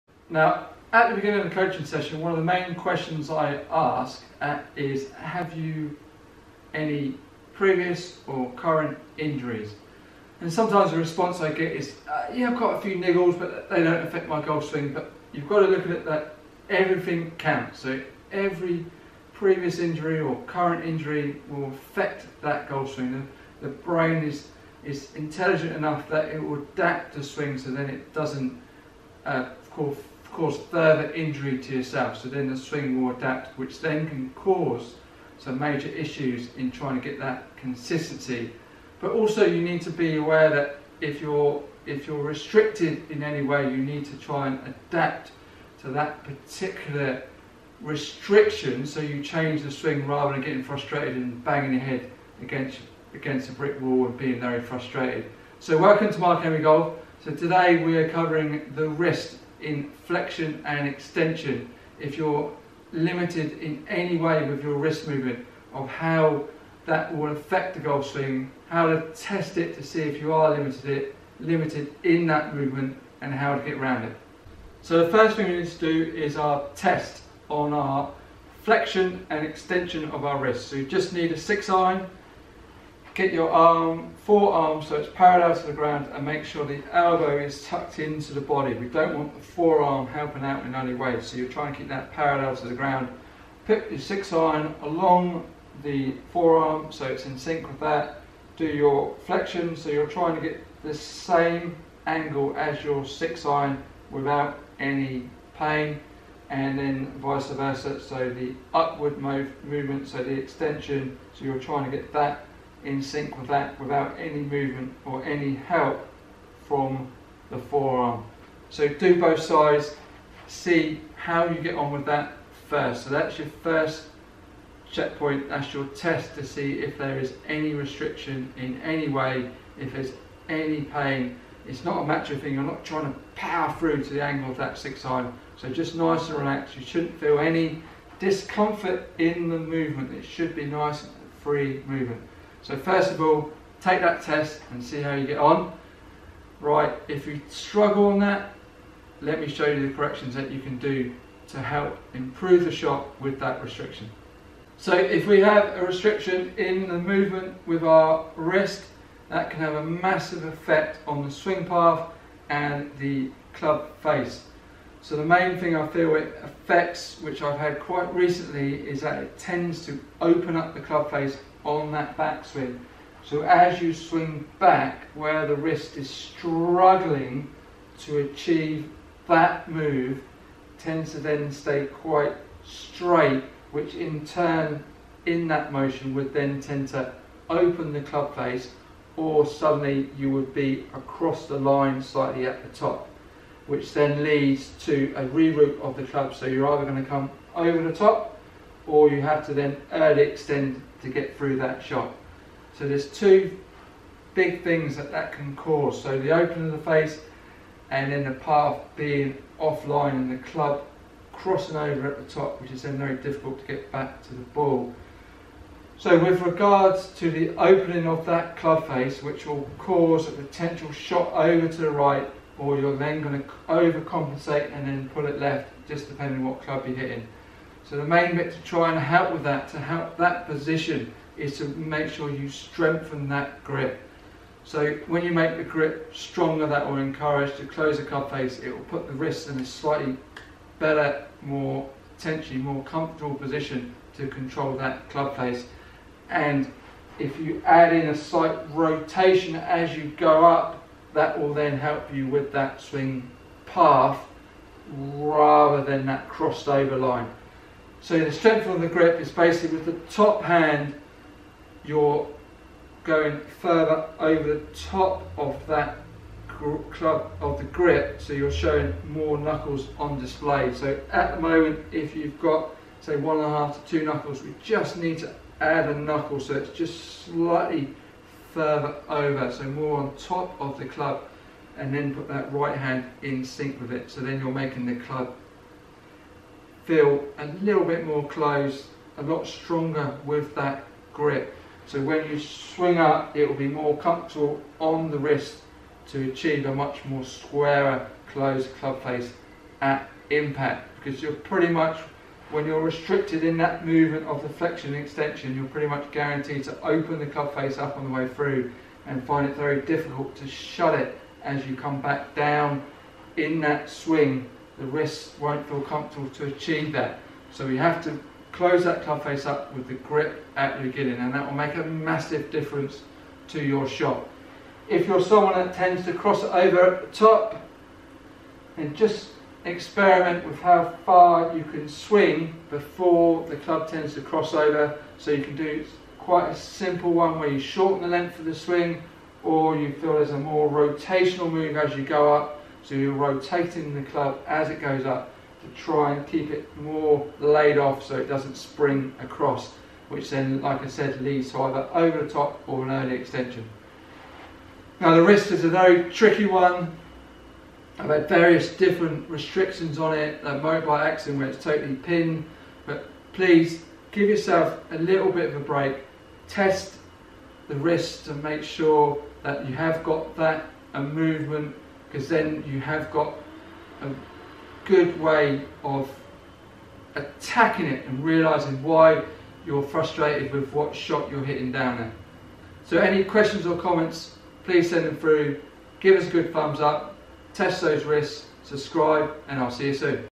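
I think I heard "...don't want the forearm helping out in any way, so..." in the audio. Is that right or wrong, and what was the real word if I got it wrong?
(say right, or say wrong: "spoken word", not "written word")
right.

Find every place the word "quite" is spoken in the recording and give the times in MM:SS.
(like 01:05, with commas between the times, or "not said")
02:47, 03:01, 05:36.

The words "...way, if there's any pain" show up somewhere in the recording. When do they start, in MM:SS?
02:09.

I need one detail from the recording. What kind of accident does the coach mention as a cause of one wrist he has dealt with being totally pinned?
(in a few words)
motorbike accident.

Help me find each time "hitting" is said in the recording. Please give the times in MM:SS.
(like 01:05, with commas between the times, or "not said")
03:46, 06:21.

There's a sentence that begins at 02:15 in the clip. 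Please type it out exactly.
So just nice and relaxed, you shouldn't feel any discomfort in the movement.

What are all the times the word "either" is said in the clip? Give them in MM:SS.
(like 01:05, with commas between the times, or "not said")
03:16, 05:51.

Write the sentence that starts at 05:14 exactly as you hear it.
The wrists won't feel comfortable to achieve that.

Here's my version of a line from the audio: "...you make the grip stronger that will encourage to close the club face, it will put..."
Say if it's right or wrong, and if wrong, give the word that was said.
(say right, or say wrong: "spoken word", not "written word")
right.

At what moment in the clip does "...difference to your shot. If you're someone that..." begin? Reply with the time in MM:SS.
05:22.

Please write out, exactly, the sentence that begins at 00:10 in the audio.
And sometimes the response I get is uh, Yeah, I've got a few niggles, but they don't affect my golf swing.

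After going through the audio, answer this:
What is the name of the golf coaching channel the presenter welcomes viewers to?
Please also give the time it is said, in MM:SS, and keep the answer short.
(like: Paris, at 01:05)
Mark Amey Golf, at 00:56.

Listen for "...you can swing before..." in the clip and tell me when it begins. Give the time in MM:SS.
05:31.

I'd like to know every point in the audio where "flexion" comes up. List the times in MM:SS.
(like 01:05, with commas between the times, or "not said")
01:00, 01:18, 01:39, 05:04.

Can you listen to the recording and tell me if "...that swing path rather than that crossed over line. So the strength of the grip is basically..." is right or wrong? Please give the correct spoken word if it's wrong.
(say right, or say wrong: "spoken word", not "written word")
right.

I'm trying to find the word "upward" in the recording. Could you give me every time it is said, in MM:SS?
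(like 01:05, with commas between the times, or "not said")
01:48.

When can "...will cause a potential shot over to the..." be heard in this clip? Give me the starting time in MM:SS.
03:39.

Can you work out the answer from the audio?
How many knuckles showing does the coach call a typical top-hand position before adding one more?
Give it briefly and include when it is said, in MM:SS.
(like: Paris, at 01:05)
1.5 to 2, at 04:33.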